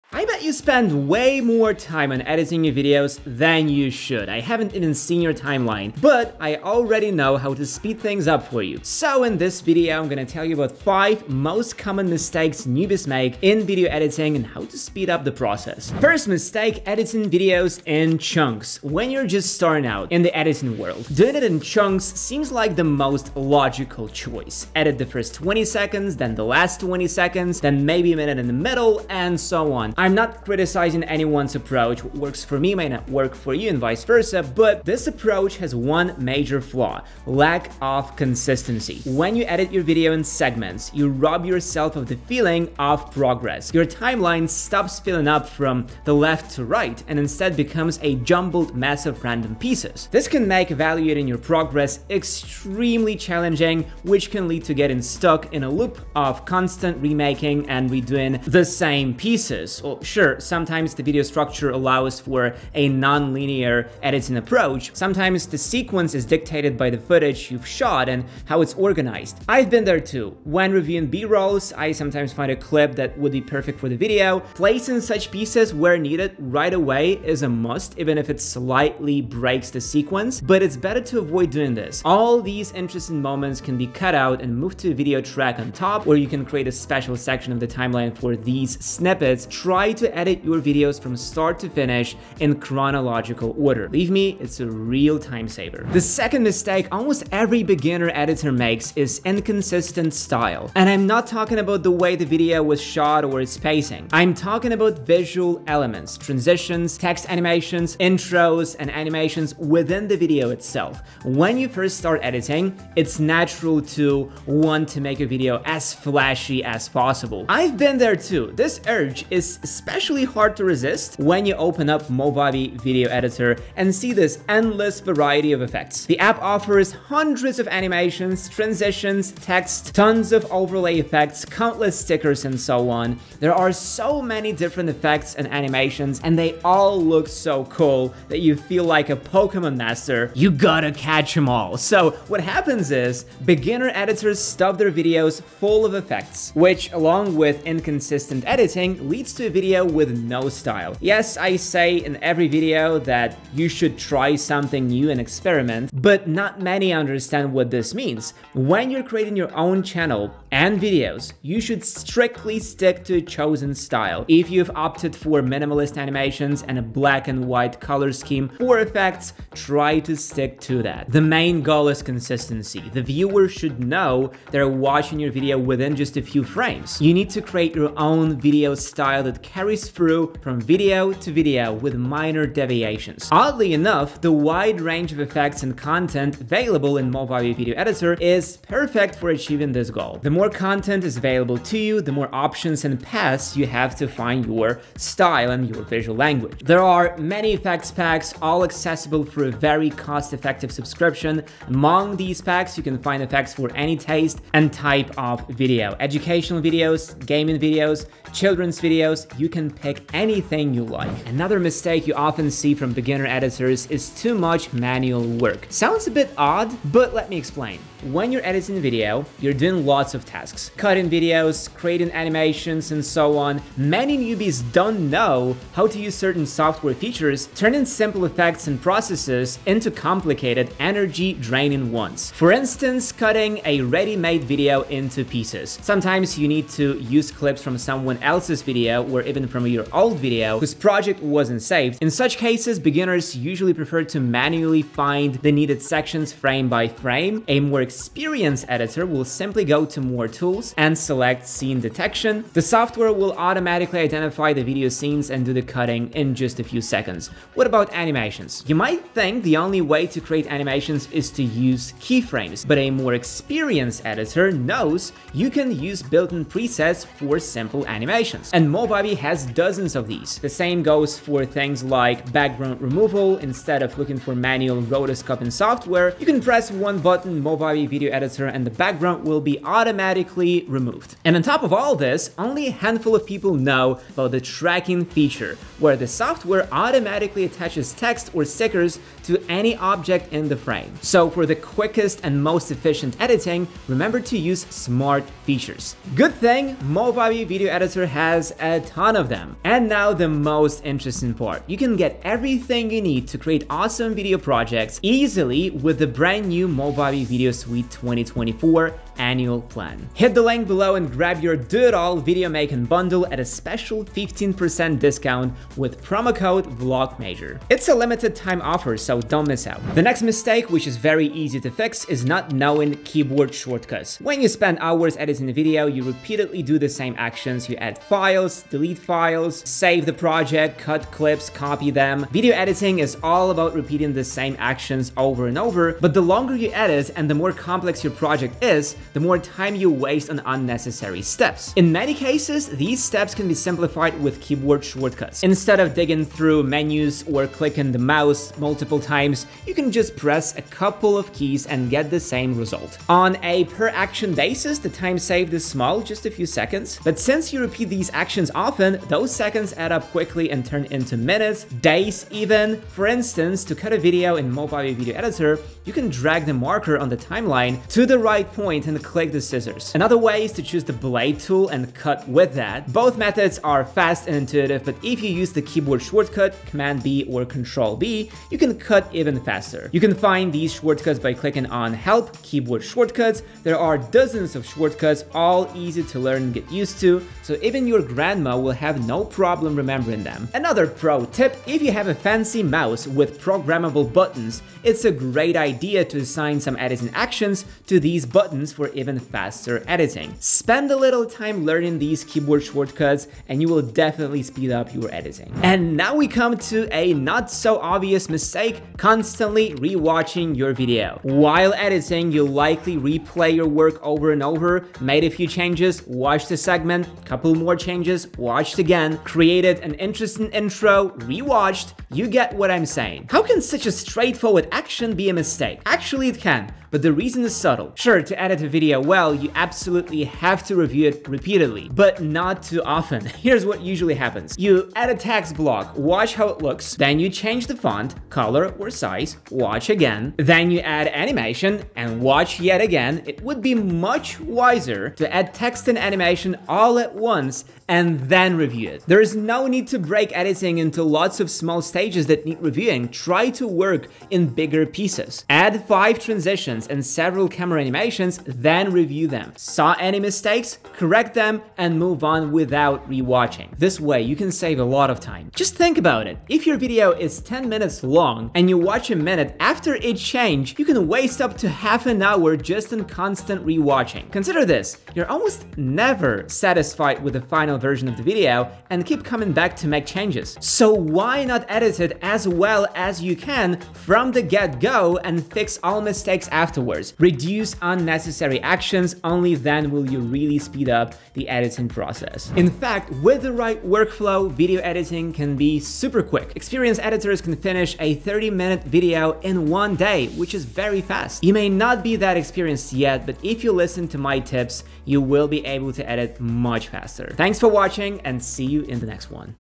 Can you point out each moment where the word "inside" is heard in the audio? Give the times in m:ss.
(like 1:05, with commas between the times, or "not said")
not said.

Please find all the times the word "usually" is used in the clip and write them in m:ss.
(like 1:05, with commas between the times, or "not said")
4:03, 7:13.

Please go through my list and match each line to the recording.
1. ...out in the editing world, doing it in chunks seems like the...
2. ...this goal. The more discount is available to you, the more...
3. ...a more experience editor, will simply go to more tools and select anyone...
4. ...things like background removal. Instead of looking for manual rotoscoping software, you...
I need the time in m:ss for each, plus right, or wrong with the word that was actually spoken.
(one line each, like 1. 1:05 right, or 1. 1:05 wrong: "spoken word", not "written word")
1. 0:19 right
2. 3:09 wrong: "content", not "discount"
3. 4:07 wrong: "scene", not "anyone"
4. 4:31 right.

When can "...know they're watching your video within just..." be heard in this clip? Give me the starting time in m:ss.
2:53.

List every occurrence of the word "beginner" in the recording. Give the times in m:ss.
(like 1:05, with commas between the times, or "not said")
1:37, 2:23, 3:32, 4:02.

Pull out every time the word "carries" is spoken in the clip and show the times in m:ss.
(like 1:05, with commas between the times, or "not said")
2:59.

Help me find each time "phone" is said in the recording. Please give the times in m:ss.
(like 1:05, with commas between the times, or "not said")
not said.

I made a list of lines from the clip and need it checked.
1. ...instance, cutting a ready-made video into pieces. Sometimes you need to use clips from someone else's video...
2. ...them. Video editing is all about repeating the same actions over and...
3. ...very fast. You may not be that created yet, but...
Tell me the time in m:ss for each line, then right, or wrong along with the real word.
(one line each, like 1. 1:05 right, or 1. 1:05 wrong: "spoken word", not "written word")
1. 3:52 right
2. 5:31 right
3. 8:20 wrong: "experienced", not "created".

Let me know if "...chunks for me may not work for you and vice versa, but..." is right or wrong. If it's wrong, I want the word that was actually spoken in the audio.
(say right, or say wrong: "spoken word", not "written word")
wrong: "works", not "chunks".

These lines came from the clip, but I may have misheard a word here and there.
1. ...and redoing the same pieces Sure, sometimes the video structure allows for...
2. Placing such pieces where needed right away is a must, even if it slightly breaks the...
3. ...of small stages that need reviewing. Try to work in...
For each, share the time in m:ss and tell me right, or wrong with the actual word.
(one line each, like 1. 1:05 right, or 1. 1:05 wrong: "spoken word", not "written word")
1. 0:57 right
2. 1:14 right
3. 7:31 right.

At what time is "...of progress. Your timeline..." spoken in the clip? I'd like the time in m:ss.
0:42.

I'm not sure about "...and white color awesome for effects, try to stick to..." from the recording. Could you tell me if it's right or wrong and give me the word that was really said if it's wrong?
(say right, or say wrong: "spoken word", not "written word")
wrong: "scheme", not "awesome".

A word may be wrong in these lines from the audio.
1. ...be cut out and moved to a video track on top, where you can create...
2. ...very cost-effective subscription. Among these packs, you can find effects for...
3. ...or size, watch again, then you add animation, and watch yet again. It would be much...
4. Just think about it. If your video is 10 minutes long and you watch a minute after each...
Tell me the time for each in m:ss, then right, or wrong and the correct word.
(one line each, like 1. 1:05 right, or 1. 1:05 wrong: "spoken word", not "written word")
1. 1:23 right
2. 3:19 right
3. 7:18 right
4. 7:45 right.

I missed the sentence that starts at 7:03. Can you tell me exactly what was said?
How can such a straightforward action be a mistake?